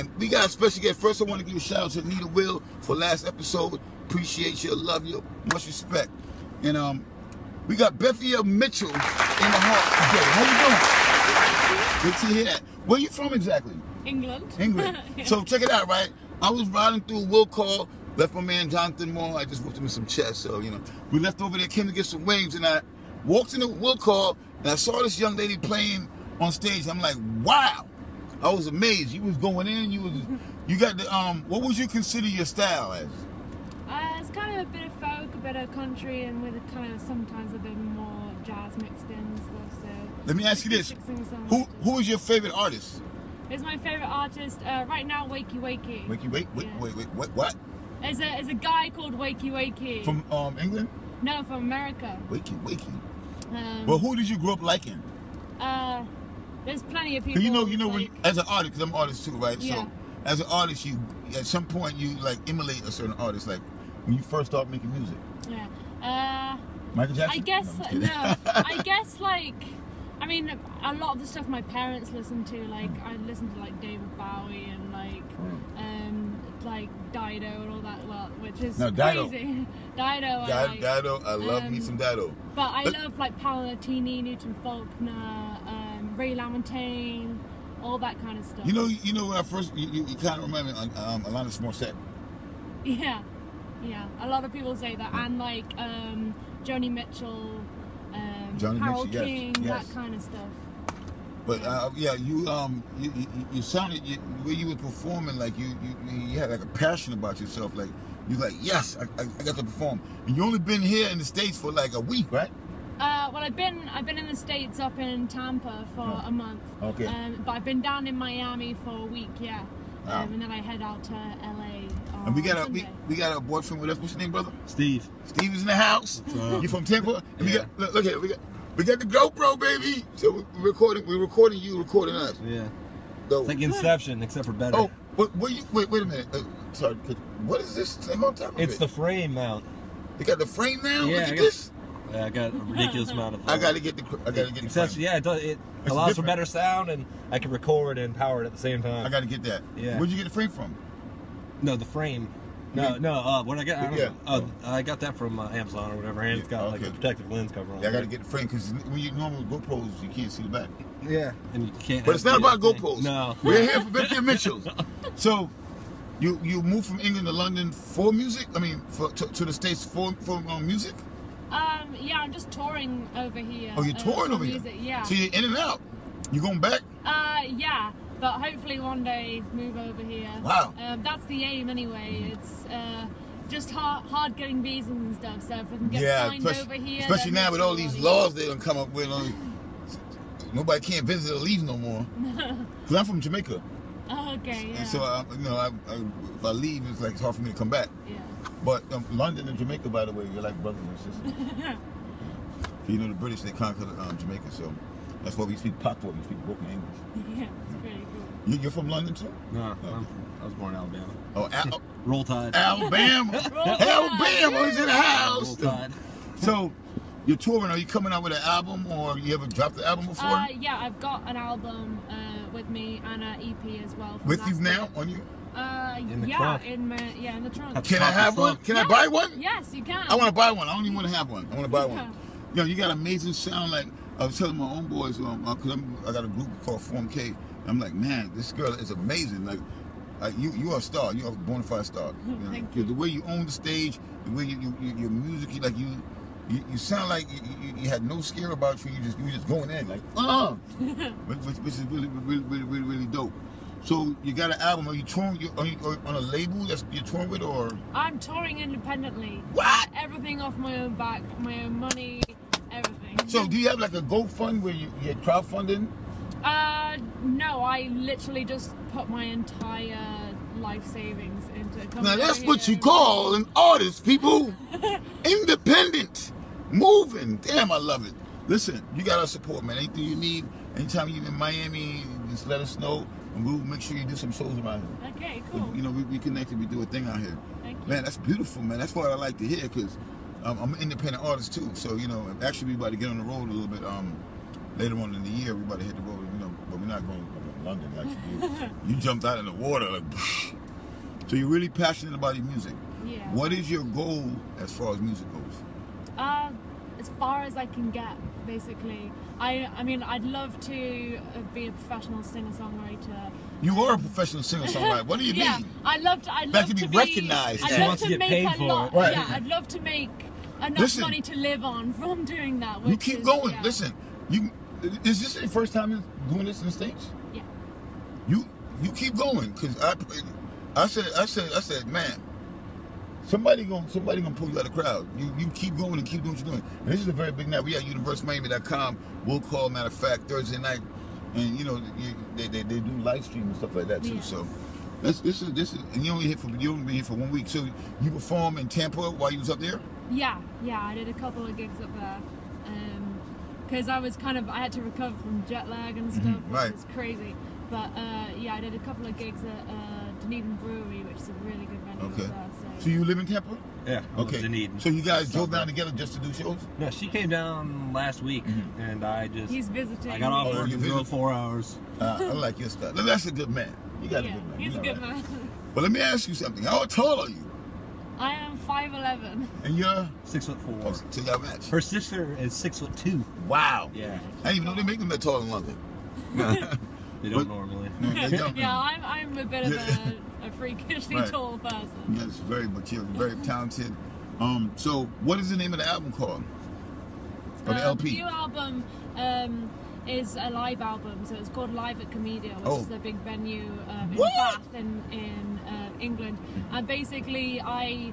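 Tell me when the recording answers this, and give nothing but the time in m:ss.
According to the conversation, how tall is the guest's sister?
6:22.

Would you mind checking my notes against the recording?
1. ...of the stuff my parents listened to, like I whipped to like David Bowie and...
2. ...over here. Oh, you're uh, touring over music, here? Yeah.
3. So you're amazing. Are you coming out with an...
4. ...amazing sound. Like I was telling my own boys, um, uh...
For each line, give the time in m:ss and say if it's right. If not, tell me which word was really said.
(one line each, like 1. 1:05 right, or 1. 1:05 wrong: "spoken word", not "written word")
1. 1:11 wrong: "listened", not "whipped"
2. 2:53 right
3. 3:36 wrong: "touring", not "amazing"
4. 3:52 right.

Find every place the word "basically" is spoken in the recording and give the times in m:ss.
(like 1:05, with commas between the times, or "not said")
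5:08, 6:46.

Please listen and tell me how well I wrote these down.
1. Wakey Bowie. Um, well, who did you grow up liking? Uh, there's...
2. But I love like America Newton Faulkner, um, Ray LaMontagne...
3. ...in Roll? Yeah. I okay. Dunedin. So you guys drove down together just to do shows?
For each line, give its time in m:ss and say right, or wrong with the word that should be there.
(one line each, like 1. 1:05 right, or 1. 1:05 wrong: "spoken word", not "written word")
1. 0:52 wrong: "Wakey", not "Bowie"
2. 1:22 wrong: "Paolo", not "America"
3. 6:03 wrong: "Tampa", not "Roll".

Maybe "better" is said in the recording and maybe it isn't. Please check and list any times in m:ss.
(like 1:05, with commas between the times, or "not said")
2:14, 2:26.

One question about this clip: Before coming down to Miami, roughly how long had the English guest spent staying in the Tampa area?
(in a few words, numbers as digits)
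a month.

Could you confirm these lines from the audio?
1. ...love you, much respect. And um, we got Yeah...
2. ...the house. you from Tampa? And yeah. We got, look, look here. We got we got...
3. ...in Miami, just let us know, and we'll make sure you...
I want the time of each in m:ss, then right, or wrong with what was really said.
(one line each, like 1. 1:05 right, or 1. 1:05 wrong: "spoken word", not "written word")
1. 0:04 wrong: "Bethia", not "Yeah"
2. 2:05 right
3. 4:41 right.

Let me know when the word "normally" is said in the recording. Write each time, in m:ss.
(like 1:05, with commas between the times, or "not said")
2:39, 6:27.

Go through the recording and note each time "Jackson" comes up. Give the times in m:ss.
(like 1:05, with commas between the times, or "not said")
1:07.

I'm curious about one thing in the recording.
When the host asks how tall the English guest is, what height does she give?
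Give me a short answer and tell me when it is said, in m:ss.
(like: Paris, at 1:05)
5'11", at 6:18.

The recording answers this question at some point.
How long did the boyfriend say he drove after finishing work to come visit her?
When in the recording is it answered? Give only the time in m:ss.
6:11.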